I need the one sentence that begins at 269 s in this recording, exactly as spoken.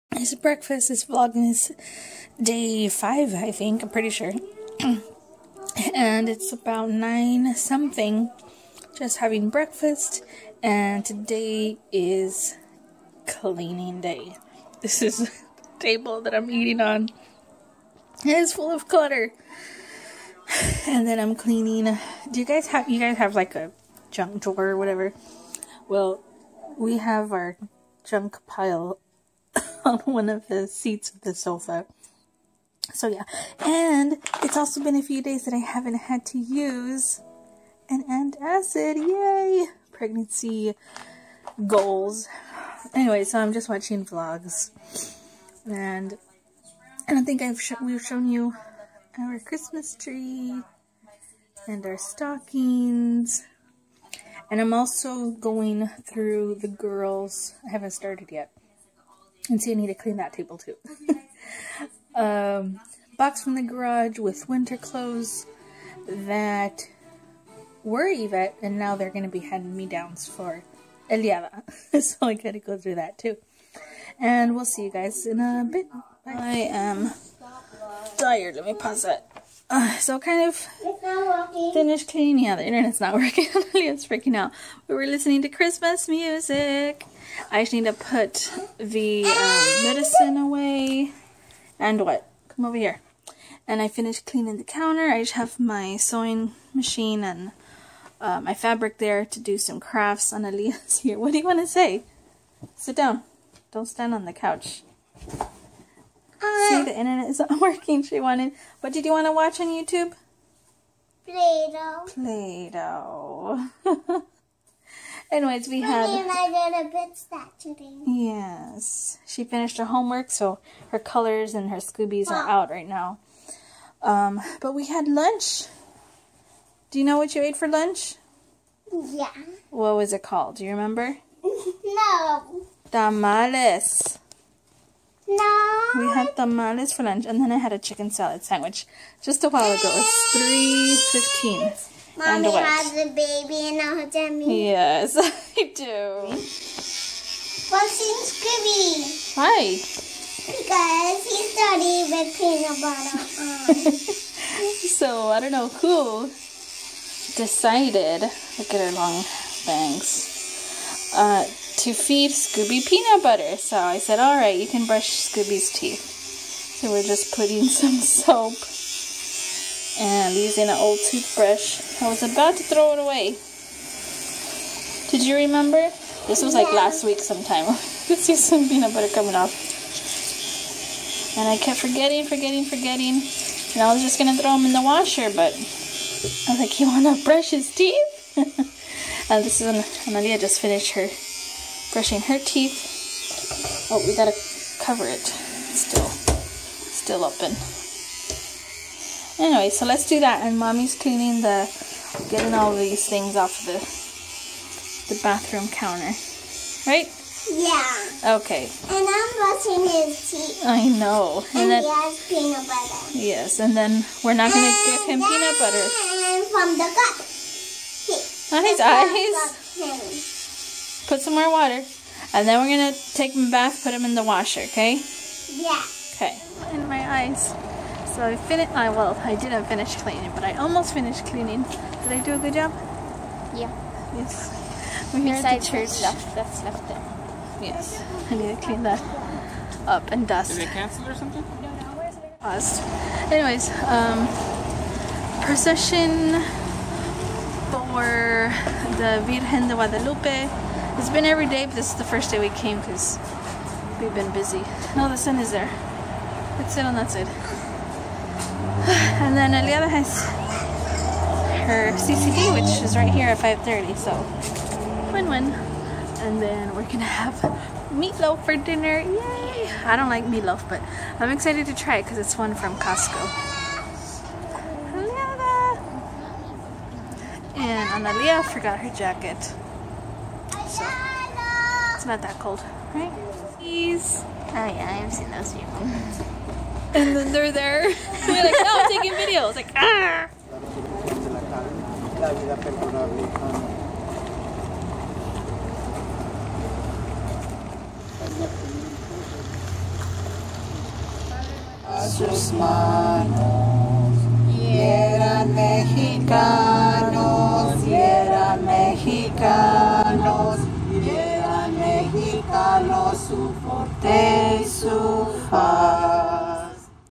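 I don't like meatloaf, but I'm excited to try it because it's one from Costco.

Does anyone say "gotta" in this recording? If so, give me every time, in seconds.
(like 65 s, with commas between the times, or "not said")
72 s, 194 s.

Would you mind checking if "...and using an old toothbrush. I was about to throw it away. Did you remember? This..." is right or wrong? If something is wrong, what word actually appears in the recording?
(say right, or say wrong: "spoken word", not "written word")
right.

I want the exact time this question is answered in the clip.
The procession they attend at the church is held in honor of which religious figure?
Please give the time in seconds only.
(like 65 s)
249 s.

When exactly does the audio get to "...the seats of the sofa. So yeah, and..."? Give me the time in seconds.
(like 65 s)
30 s.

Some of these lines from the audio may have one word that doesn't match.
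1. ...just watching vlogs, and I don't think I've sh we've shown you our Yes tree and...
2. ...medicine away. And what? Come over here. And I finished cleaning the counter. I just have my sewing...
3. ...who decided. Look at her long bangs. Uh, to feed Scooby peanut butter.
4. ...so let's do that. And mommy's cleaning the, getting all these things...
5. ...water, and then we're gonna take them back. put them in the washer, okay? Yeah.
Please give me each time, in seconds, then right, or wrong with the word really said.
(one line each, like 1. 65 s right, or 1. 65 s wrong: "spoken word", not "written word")
1. 43 s wrong: "Christmas", not "Yes"
2. 89 s right
3. 155 s right
4. 199 s right
5. 221 s right.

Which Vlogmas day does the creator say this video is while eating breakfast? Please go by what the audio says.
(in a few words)
5.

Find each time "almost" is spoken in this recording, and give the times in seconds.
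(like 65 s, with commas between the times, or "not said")
230 s.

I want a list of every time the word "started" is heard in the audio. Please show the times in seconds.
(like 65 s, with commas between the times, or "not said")
57 s, 151 s.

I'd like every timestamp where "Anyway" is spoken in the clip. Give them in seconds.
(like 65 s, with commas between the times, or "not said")
42 s, 115 s, 199 s, 243 s.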